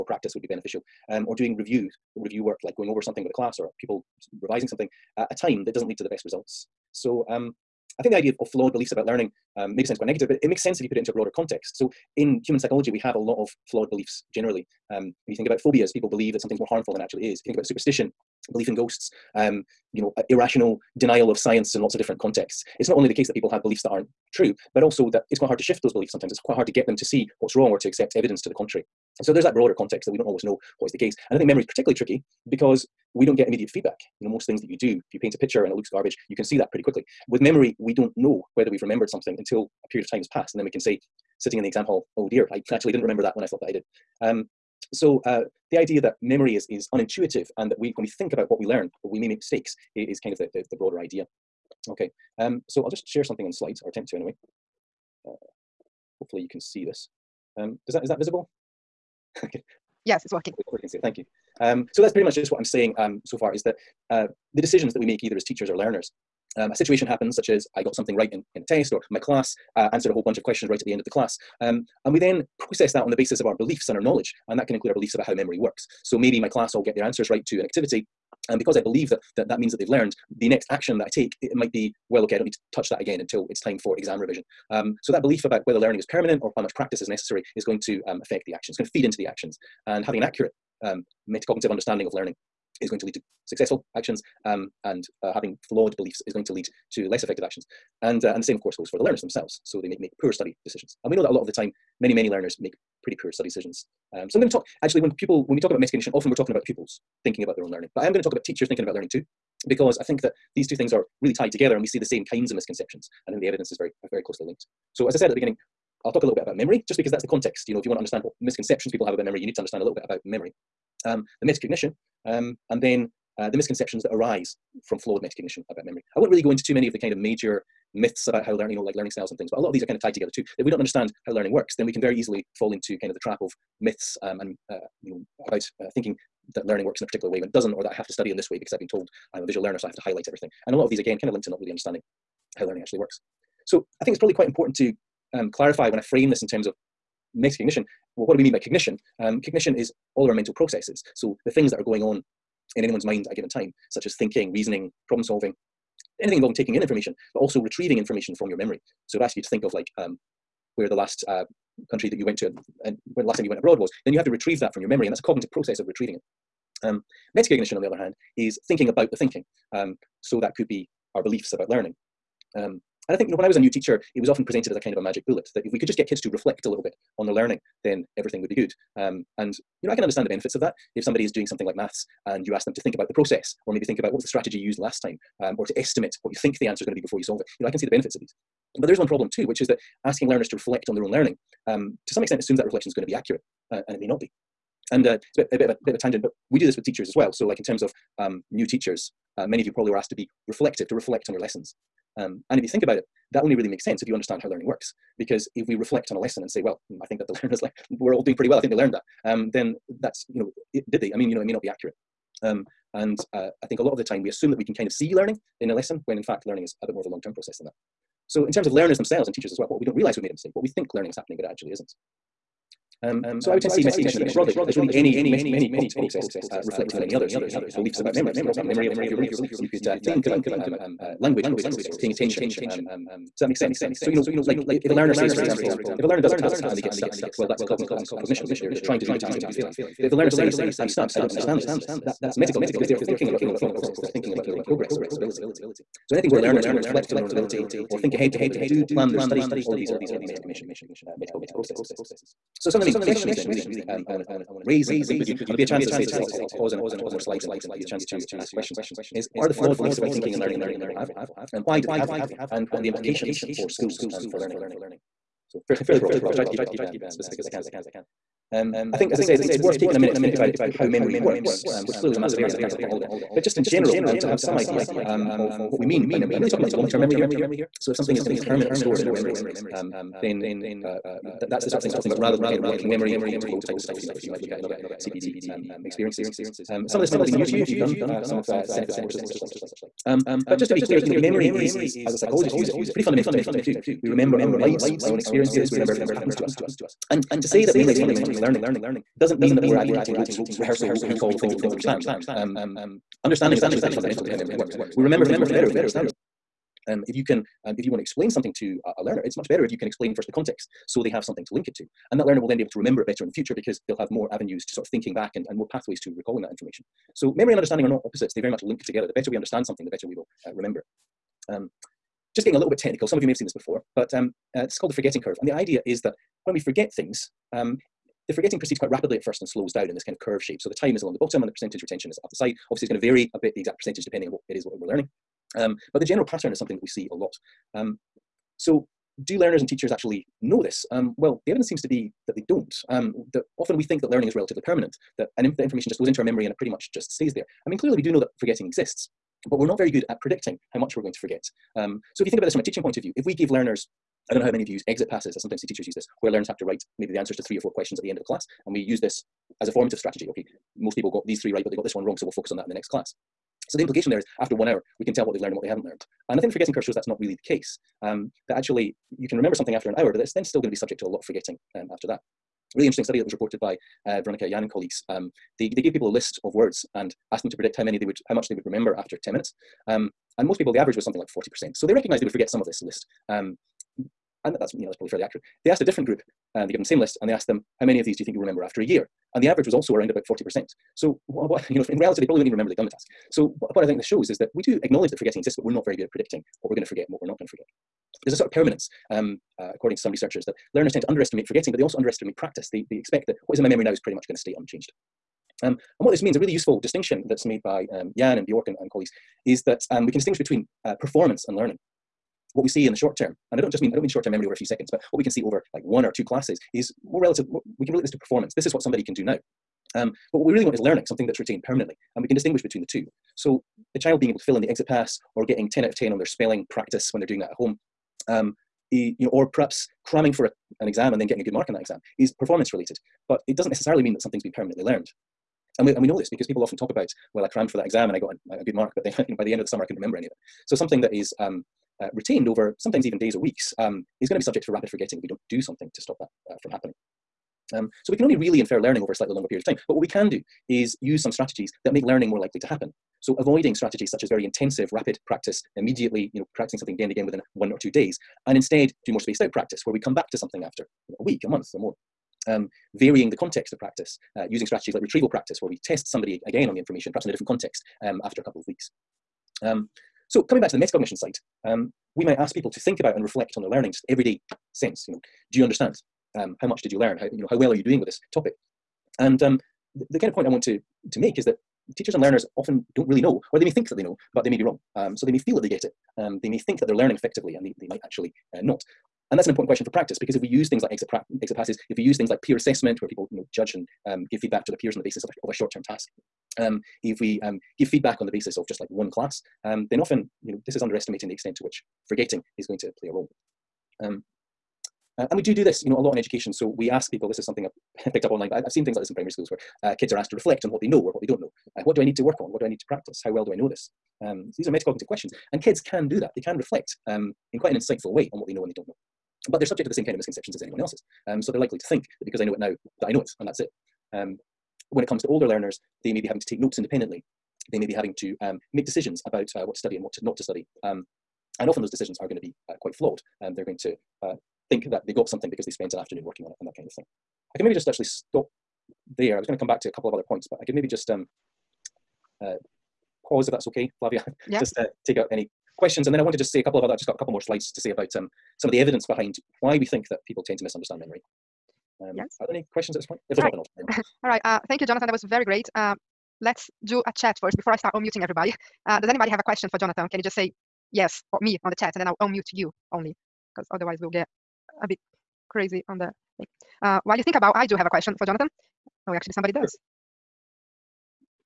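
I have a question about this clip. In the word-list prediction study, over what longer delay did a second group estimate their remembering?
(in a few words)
a year.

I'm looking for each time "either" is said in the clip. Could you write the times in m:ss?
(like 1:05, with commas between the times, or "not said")
1:05.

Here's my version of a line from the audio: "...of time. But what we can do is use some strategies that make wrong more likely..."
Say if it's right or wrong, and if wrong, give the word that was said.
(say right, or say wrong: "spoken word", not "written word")
wrong: "learning", not "wrong".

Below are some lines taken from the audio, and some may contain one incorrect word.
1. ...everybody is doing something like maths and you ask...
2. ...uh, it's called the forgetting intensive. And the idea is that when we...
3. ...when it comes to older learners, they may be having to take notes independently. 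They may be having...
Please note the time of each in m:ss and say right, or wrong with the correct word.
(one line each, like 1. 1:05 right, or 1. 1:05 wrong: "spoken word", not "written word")
1. 3:01 wrong: "somebody", not "everybody"
2. 5:24 wrong: "curve", not "intensive"
3. 8:44 right.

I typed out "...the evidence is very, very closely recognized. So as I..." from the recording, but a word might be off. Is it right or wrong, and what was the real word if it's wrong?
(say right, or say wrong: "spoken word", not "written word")
wrong: "linked", not "recognized".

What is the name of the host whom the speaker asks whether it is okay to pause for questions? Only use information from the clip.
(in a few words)
Flavia.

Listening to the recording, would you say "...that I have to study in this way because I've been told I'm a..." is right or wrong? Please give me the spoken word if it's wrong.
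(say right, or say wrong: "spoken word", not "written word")
right.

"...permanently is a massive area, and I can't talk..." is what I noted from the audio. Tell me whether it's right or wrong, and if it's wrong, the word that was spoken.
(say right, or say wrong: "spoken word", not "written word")
wrong: "clearly", not "permanently".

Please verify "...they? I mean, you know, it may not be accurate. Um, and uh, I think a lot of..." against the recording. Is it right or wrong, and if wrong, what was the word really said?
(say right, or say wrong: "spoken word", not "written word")
right.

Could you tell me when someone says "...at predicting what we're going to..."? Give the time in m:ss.
6:36.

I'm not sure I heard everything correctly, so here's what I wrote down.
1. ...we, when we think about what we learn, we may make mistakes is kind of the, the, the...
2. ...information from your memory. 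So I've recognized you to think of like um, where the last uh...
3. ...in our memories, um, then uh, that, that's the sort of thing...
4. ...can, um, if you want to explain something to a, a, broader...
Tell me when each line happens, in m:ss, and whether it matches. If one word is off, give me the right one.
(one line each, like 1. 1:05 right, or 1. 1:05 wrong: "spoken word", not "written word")
1. 0:47 right
2. 2:37 wrong: "asked", not "recognized"
3. 4:38 right
4. 5:07 wrong: "learner", not "broader".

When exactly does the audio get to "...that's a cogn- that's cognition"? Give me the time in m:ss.
3:57.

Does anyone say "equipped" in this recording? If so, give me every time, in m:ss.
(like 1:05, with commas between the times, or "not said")
not said.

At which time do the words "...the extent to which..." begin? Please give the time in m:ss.
8:21.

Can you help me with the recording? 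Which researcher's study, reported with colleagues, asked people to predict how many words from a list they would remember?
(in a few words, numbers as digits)
Veronica Yan.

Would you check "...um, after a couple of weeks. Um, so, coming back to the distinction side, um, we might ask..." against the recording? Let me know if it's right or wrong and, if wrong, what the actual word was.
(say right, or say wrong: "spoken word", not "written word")
wrong: "metacognition", not "distinction".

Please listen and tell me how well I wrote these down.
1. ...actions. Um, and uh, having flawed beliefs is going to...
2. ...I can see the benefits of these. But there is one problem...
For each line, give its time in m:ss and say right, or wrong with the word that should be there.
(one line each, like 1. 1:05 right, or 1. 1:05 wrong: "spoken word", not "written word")
1. 1:33 right
2. 3:07 right.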